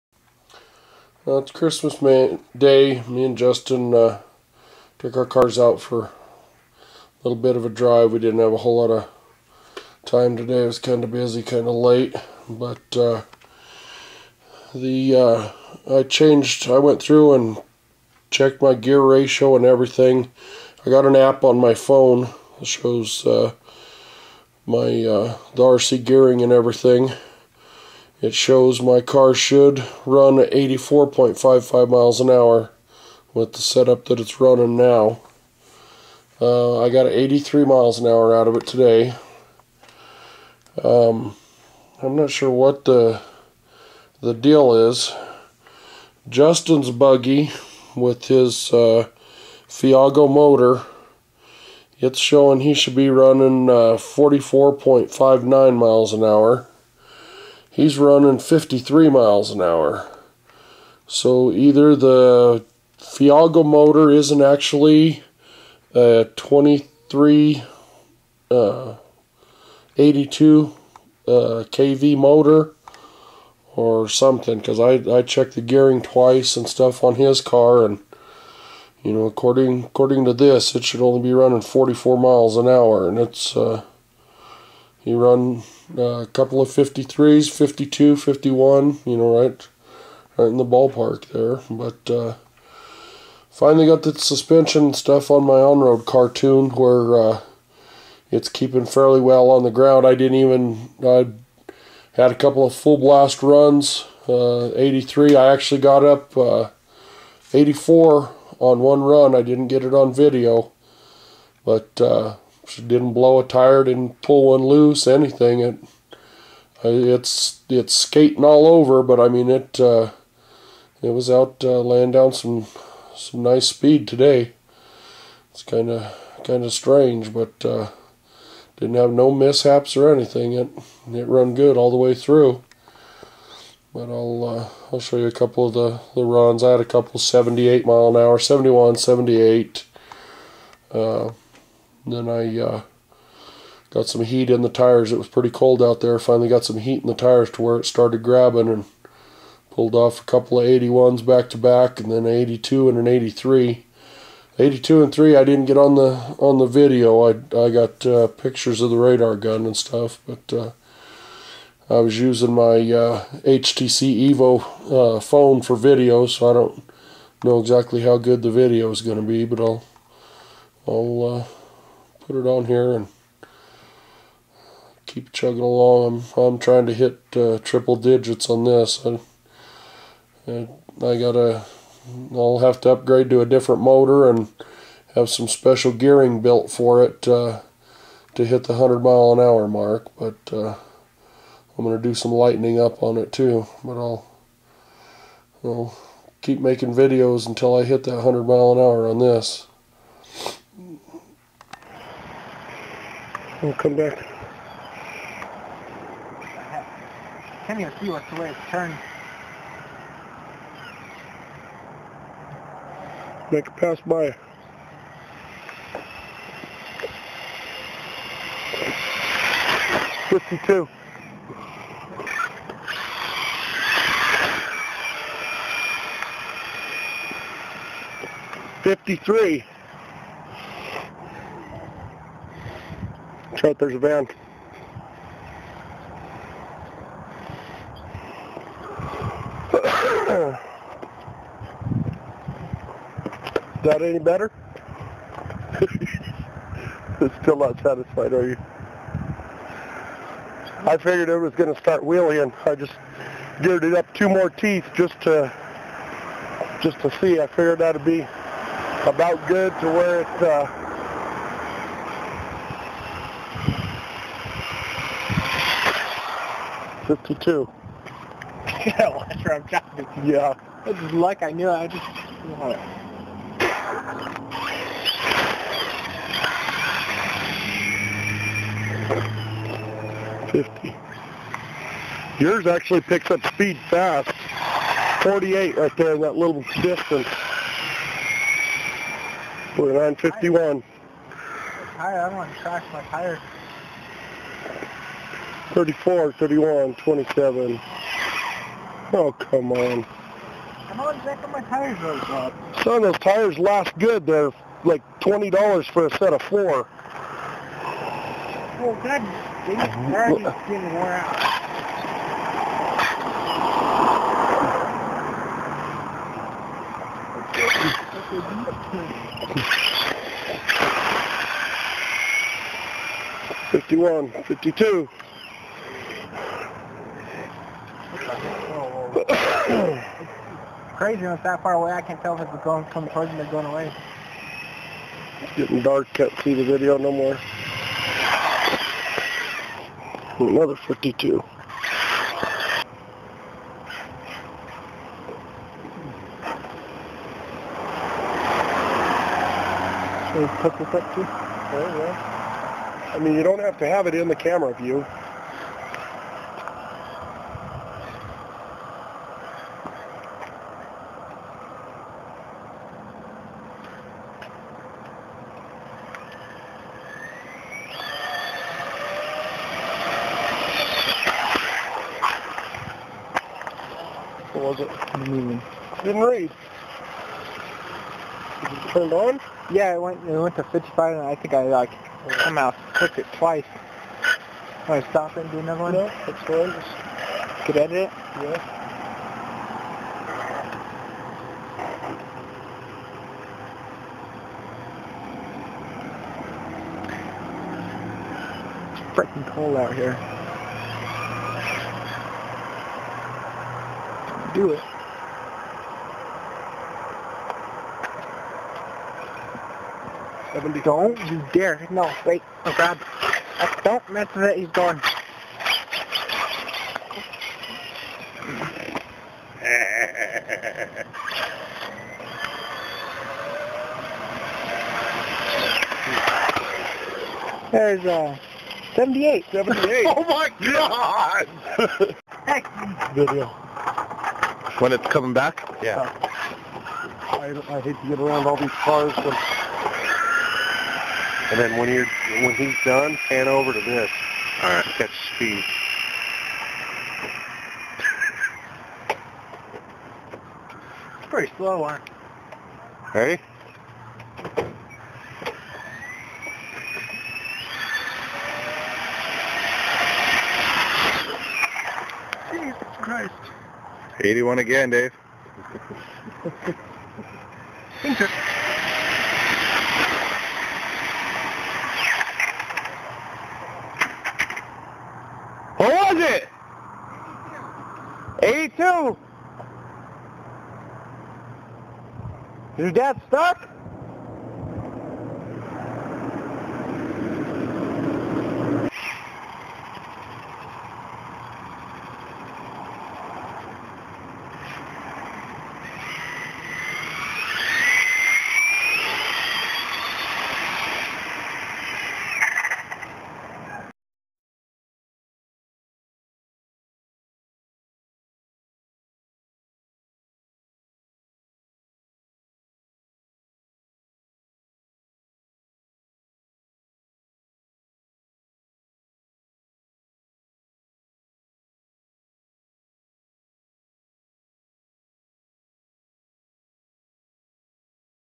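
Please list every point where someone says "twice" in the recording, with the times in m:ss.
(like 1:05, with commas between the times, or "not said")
1:16, 6:23.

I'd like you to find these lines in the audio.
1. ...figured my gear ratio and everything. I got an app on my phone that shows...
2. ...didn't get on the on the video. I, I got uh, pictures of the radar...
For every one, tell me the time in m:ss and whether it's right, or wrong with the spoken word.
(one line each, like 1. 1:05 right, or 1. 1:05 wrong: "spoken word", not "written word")
1. 0:18 wrong: "checked", not "figured"
2. 2:35 right.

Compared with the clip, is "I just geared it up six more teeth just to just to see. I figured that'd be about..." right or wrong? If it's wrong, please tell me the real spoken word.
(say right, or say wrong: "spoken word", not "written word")
wrong: "two", not "six".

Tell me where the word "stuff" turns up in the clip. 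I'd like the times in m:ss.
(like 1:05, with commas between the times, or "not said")
1:16, 1:34, 2:39.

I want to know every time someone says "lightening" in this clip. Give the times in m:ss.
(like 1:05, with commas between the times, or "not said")
3:12.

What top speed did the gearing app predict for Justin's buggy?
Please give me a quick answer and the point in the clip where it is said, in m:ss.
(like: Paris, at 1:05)
44.59 mph, at 0:53.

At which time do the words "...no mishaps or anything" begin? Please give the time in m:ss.
2:09.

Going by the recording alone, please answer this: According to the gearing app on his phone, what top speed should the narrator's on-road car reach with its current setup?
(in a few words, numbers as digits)
84.55 mph.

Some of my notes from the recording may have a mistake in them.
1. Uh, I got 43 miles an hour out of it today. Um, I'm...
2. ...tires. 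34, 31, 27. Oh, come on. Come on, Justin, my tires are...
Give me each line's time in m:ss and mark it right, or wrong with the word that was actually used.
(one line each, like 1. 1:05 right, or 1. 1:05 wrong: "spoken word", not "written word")
1. 0:36 wrong: "83", not "43"
2. 4:53 wrong: "Jack", not "Justin".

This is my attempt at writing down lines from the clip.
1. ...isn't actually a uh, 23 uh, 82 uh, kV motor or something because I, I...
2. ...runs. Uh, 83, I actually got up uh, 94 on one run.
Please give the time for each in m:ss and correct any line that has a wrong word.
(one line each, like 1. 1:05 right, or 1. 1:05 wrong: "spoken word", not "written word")
1. 1:04 right
2. 1:43 wrong: "84", not "94".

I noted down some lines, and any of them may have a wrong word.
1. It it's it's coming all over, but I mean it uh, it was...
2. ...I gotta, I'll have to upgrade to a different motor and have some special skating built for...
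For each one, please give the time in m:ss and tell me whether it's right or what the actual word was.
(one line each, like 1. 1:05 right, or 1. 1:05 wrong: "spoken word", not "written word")
1. 1:55 wrong: "skating", not "coming"
2. 3:01 wrong: "gearing", not "skating".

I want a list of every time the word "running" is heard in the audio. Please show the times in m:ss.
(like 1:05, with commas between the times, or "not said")
0:34, 0:53, 0:57, 1:21.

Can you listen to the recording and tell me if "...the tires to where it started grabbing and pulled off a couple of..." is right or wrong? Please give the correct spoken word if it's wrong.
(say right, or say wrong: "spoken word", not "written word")
right.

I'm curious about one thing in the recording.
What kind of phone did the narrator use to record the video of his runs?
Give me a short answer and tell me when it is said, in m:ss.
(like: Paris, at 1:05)
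HTC Evo, at 2:43.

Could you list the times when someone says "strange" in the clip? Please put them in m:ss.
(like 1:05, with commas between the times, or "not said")
2:06.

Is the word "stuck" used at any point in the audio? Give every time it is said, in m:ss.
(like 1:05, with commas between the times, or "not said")
8:03.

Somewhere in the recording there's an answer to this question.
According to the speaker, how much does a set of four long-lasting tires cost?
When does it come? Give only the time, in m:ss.
5:05.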